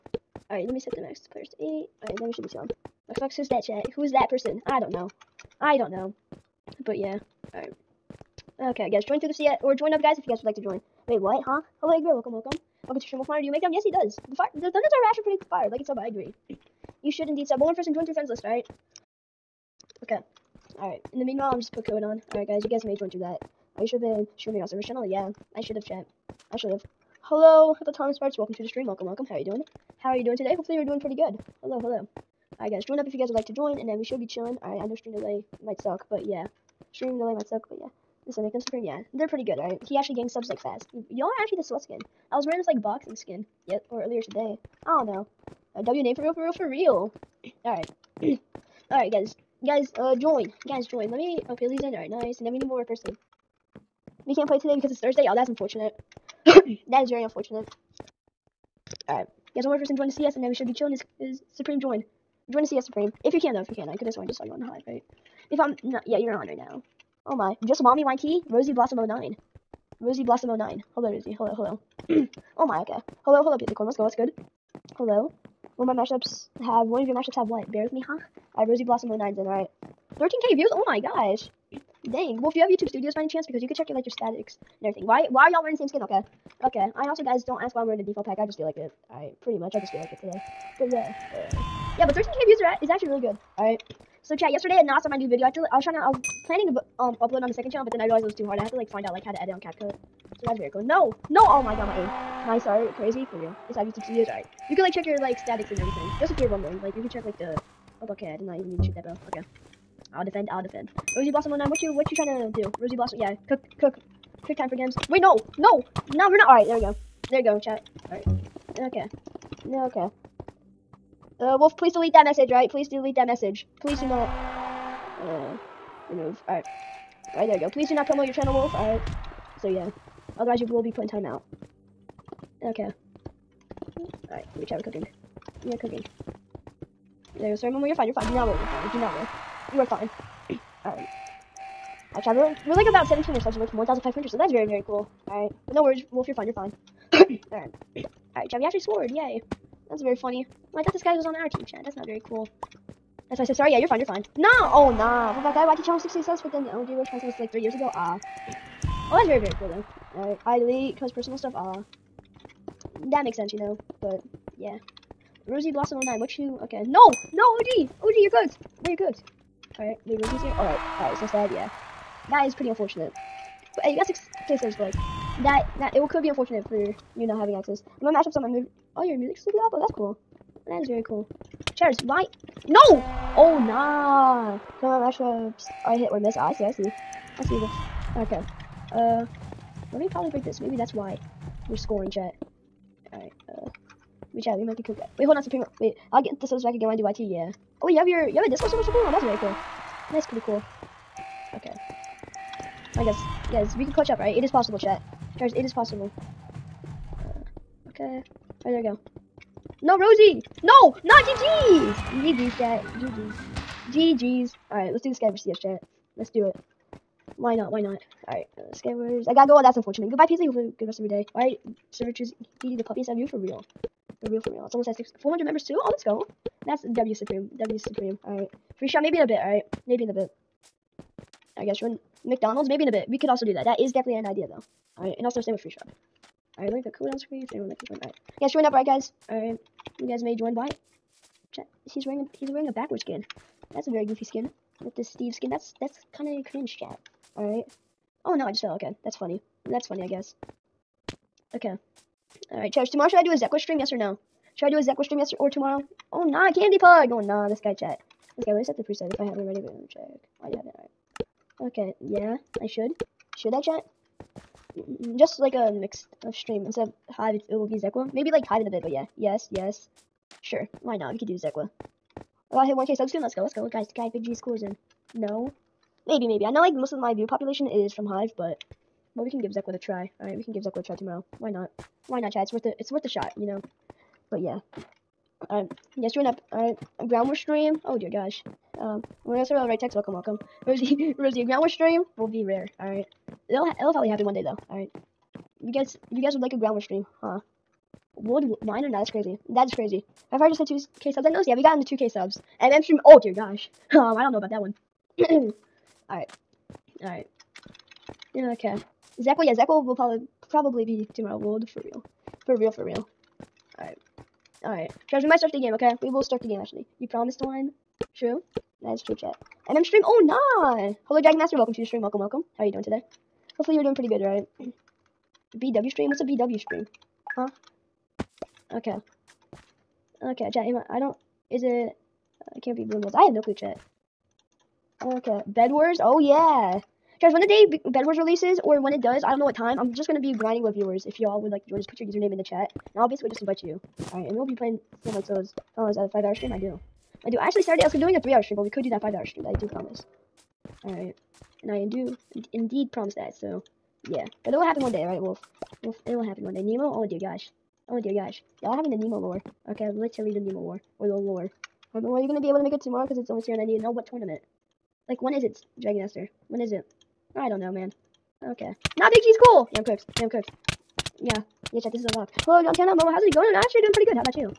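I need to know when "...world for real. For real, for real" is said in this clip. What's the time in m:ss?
5:11.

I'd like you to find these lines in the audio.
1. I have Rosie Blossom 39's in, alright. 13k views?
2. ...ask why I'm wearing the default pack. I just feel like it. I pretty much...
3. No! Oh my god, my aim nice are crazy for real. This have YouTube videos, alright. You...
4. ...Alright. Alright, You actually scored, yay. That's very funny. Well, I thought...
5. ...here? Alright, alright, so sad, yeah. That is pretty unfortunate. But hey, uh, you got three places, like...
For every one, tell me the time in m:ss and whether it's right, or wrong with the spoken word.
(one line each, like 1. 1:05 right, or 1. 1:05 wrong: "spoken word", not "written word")
1. 1:18 wrong: "09", not "39"
2. 1:27 right
3. 1:41 right
4. 2:27 right
5. 2:50 wrong: "six", not "three".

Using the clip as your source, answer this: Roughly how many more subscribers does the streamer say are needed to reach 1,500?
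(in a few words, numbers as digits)
17.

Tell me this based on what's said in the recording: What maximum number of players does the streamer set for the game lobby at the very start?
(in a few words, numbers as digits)
8.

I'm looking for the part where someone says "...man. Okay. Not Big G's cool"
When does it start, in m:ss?
6:07.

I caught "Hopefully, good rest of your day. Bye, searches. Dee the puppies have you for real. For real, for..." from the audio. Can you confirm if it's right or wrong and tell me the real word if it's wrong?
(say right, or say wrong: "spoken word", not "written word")
right.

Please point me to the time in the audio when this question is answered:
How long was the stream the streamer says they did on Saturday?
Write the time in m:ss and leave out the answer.
5:48.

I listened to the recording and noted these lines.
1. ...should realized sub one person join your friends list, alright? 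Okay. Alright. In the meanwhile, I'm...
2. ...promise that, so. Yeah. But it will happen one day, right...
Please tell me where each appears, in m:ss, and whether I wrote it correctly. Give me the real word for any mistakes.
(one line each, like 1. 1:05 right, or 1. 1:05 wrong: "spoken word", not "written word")
1. 0:17 wrong: "indeed", not "realized"
2. 5:52 right.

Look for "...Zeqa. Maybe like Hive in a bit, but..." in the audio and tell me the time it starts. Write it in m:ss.
4:27.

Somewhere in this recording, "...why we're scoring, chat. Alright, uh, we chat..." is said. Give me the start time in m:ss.
3:10.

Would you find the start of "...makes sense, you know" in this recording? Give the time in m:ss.
2:43.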